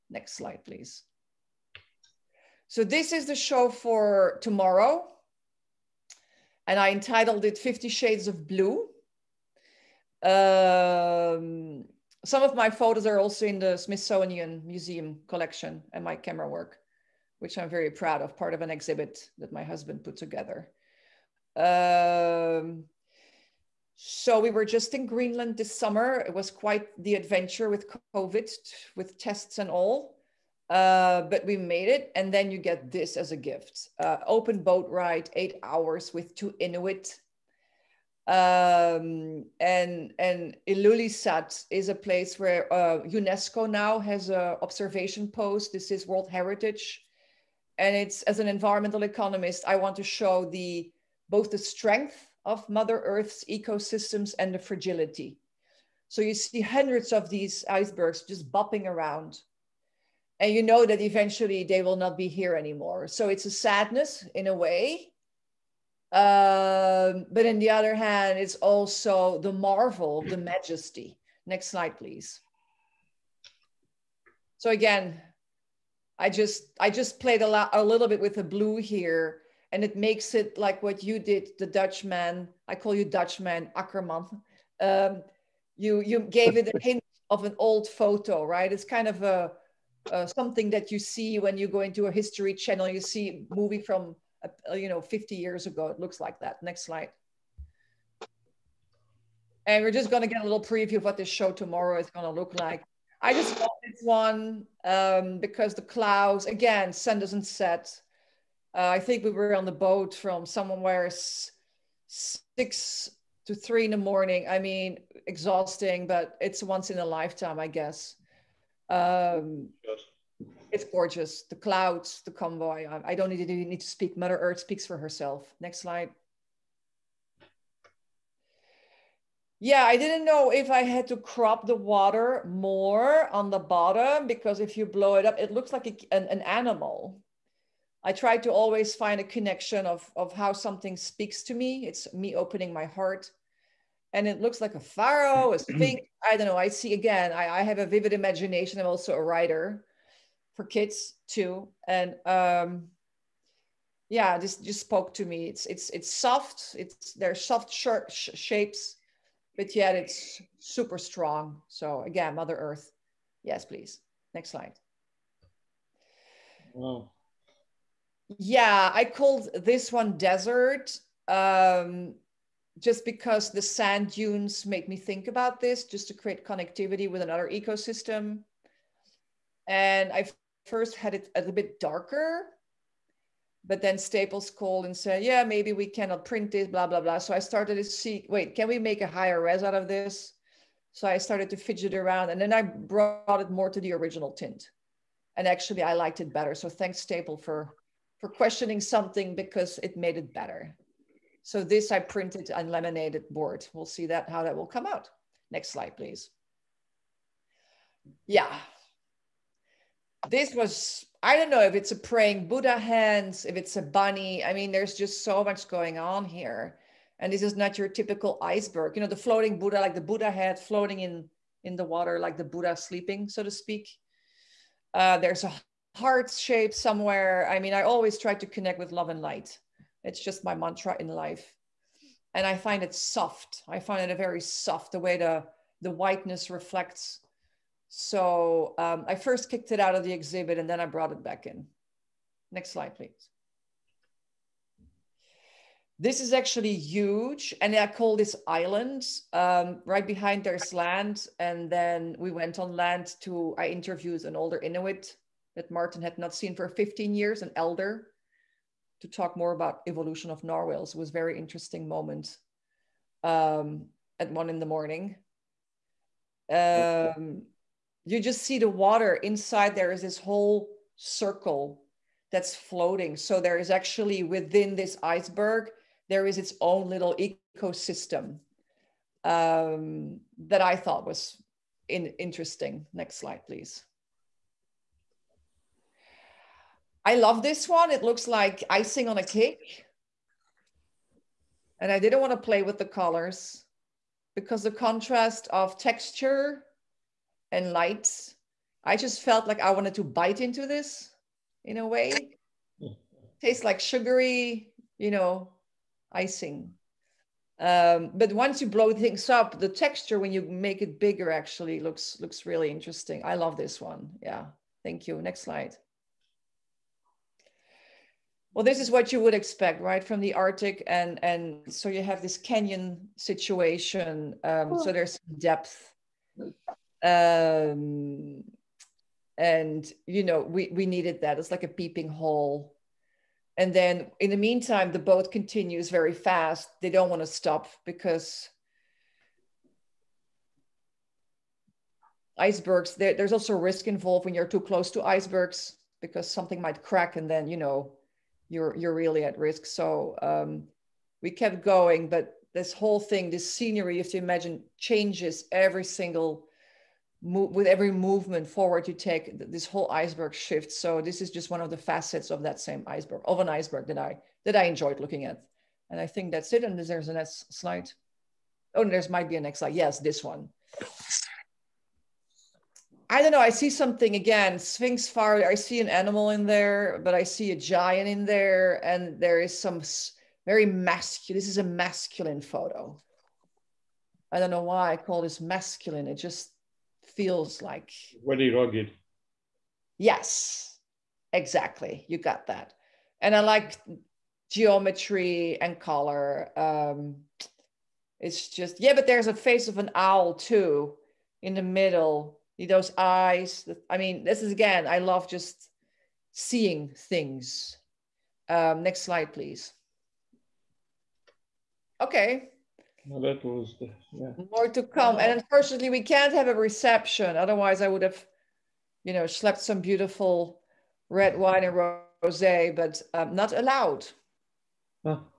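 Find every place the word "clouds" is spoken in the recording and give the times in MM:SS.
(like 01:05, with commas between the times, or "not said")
01:45, 02:01.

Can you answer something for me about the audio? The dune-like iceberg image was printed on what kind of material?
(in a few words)
laminated board.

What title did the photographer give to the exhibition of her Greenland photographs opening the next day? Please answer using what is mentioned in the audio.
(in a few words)
50 Shades of Blue.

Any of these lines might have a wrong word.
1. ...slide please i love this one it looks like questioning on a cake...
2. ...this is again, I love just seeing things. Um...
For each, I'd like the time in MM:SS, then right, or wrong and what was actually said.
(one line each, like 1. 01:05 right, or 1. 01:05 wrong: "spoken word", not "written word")
1. 04:43 wrong: "icing", not "questioning"
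2. 06:44 right.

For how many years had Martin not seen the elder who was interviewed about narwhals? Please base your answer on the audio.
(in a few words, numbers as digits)
15.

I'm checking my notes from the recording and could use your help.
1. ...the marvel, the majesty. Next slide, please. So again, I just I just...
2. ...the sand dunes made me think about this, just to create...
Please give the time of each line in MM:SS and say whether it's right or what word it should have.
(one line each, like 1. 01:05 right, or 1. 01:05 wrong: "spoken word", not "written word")
1. 01:09 right
2. 02:53 right.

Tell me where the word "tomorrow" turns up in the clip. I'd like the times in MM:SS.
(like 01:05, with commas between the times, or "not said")
00:04, 01:41.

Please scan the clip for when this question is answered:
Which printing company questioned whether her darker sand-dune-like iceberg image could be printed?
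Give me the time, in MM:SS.
03:03.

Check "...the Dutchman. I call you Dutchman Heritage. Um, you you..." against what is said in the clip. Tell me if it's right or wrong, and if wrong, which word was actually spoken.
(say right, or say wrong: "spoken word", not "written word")
wrong: "Ackerman", not "Heritage".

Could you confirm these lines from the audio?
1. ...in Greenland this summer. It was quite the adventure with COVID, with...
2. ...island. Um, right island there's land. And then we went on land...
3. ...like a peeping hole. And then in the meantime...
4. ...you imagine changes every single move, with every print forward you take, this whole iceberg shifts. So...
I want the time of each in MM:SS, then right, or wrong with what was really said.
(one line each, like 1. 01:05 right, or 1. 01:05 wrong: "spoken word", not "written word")
1. 00:24 right
2. 04:08 wrong: "behind", not "island"
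3. 05:31 right
4. 05:54 wrong: "movement", not "print".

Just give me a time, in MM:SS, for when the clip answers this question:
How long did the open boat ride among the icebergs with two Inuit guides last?
00:35.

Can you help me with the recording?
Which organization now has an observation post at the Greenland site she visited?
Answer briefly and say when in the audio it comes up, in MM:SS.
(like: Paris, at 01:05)
UNESCO, at 00:43.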